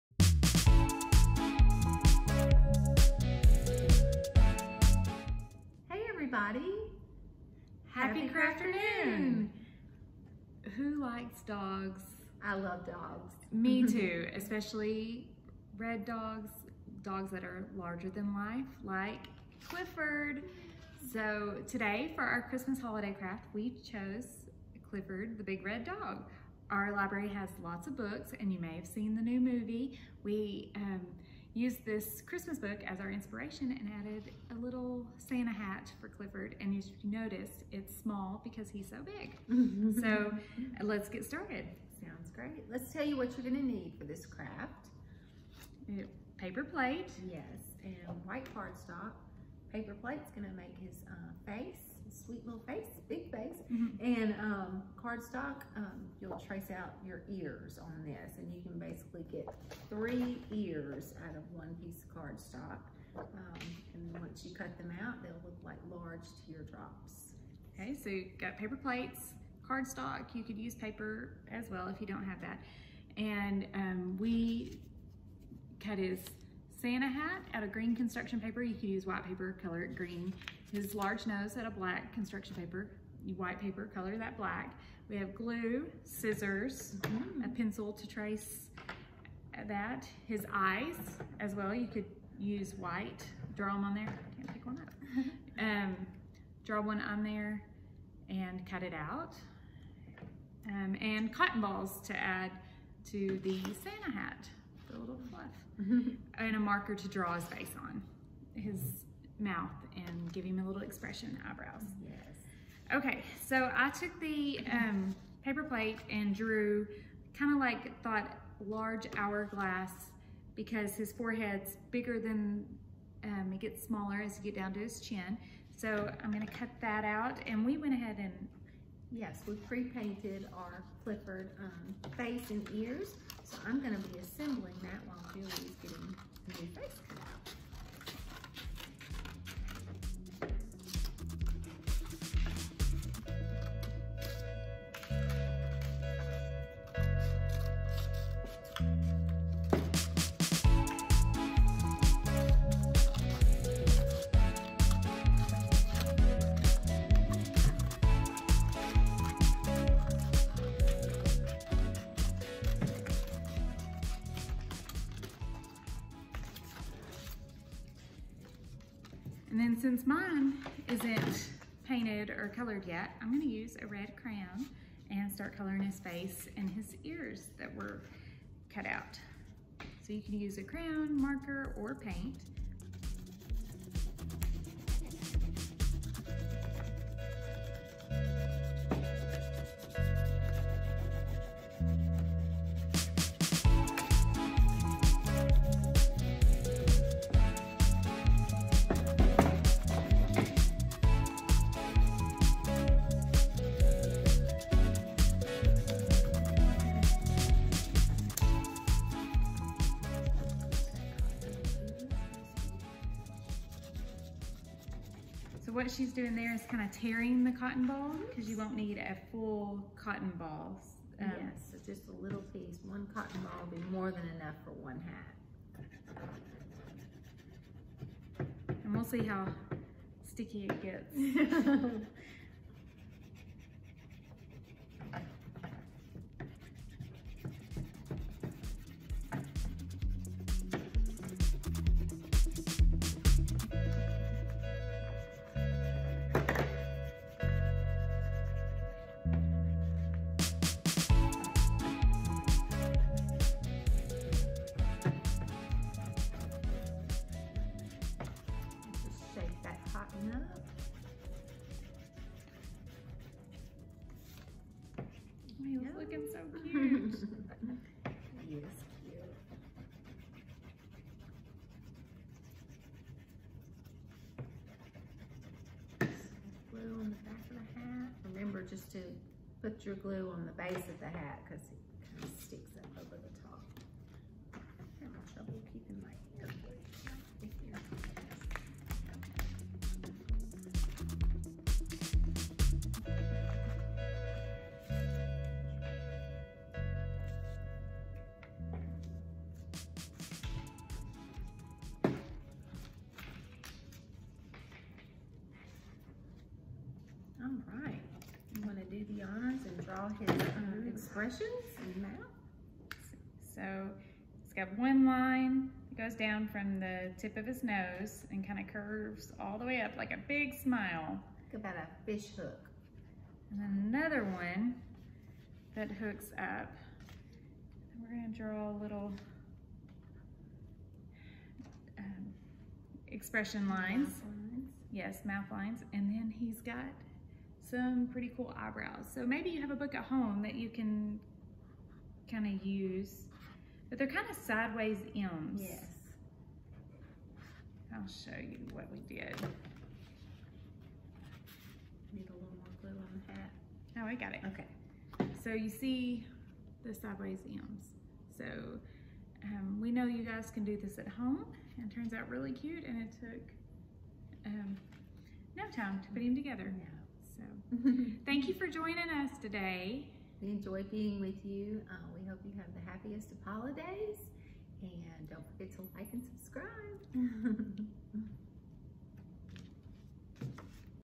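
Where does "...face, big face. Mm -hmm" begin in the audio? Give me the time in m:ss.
0:52.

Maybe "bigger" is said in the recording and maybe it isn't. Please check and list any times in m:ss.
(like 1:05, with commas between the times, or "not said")
2:01.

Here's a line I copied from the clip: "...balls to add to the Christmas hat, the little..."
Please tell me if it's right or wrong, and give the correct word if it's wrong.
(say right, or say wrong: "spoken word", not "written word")
wrong: "Santa", not "Christmas".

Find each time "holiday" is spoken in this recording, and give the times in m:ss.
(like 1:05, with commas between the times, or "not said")
0:22, 6:13.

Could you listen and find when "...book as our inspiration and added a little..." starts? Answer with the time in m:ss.
0:32.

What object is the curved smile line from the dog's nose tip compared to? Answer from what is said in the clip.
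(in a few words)
fish hook.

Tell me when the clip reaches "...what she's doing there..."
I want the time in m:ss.
3:35.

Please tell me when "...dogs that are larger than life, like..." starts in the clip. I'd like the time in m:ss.
0:17.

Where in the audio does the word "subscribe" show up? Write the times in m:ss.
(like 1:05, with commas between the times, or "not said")
6:16.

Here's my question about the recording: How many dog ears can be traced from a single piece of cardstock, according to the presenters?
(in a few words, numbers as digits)
3.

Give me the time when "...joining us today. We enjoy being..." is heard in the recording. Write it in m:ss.
6:08.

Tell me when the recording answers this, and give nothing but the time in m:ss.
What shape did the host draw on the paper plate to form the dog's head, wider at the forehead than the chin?
1:58.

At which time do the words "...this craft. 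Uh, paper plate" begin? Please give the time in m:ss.
0:44.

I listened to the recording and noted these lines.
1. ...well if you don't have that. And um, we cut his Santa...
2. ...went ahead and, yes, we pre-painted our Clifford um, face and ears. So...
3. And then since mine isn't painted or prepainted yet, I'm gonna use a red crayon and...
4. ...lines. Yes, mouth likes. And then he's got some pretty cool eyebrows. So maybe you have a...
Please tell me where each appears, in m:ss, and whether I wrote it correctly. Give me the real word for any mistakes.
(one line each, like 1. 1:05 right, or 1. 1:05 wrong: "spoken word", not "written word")
1. 1:11 right
2. 2:07 right
3. 2:49 wrong: "colored", not "prepainted"
4. 5:34 wrong: "lines", not "likes".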